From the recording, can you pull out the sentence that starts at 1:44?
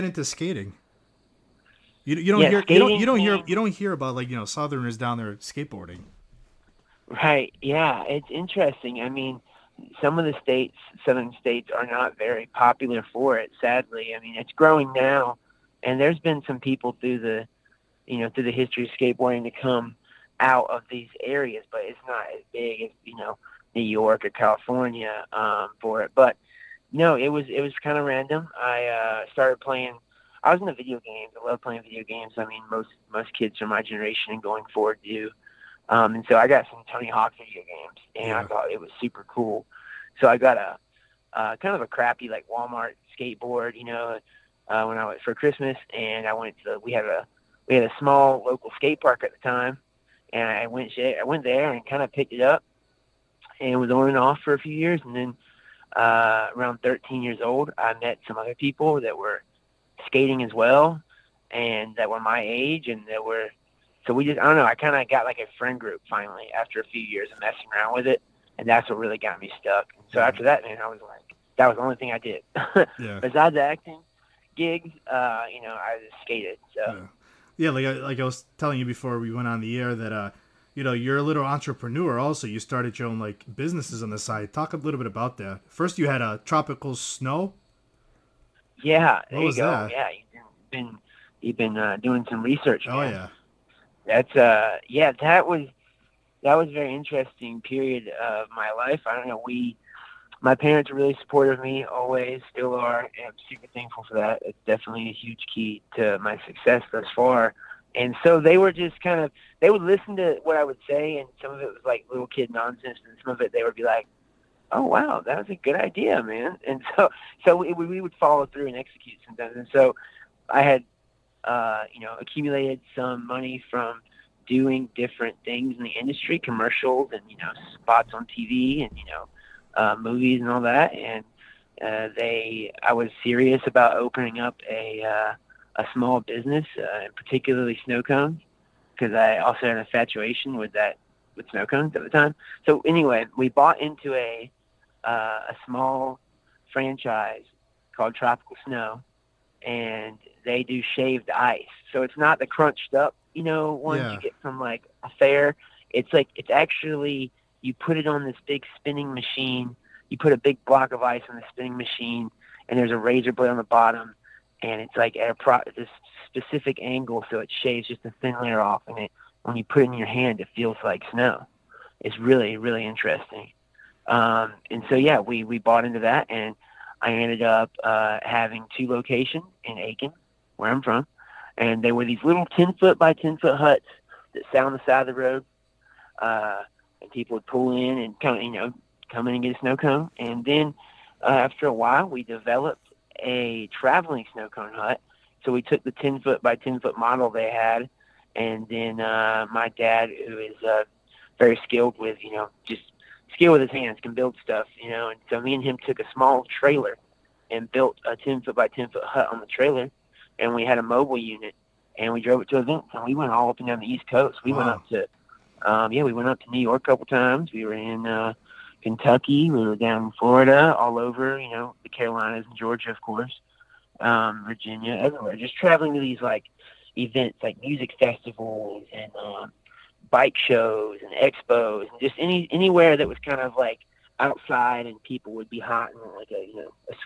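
It's definitely a huge key to my success thus far.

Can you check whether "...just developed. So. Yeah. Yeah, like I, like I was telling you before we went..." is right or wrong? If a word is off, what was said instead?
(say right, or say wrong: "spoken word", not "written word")
wrong: "skated", not "developed".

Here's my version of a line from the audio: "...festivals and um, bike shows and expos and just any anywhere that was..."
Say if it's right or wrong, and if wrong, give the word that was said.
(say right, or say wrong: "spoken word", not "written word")
right.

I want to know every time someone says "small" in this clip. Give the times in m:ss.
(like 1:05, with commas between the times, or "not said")
0:47, 2:15, 2:25, 3:26.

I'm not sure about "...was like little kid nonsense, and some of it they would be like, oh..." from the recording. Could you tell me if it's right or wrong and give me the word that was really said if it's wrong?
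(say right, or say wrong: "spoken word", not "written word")
right.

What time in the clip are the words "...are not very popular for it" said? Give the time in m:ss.
0:11.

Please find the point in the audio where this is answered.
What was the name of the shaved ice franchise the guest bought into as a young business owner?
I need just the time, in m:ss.
2:28.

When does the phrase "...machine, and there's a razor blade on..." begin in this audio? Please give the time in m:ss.
2:41.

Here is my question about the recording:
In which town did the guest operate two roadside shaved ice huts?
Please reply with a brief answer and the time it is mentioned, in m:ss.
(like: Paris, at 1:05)
Aiken, at 2:59.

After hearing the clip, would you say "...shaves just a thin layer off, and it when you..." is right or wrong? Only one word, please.
right.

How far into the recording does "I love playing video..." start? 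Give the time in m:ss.
0:31.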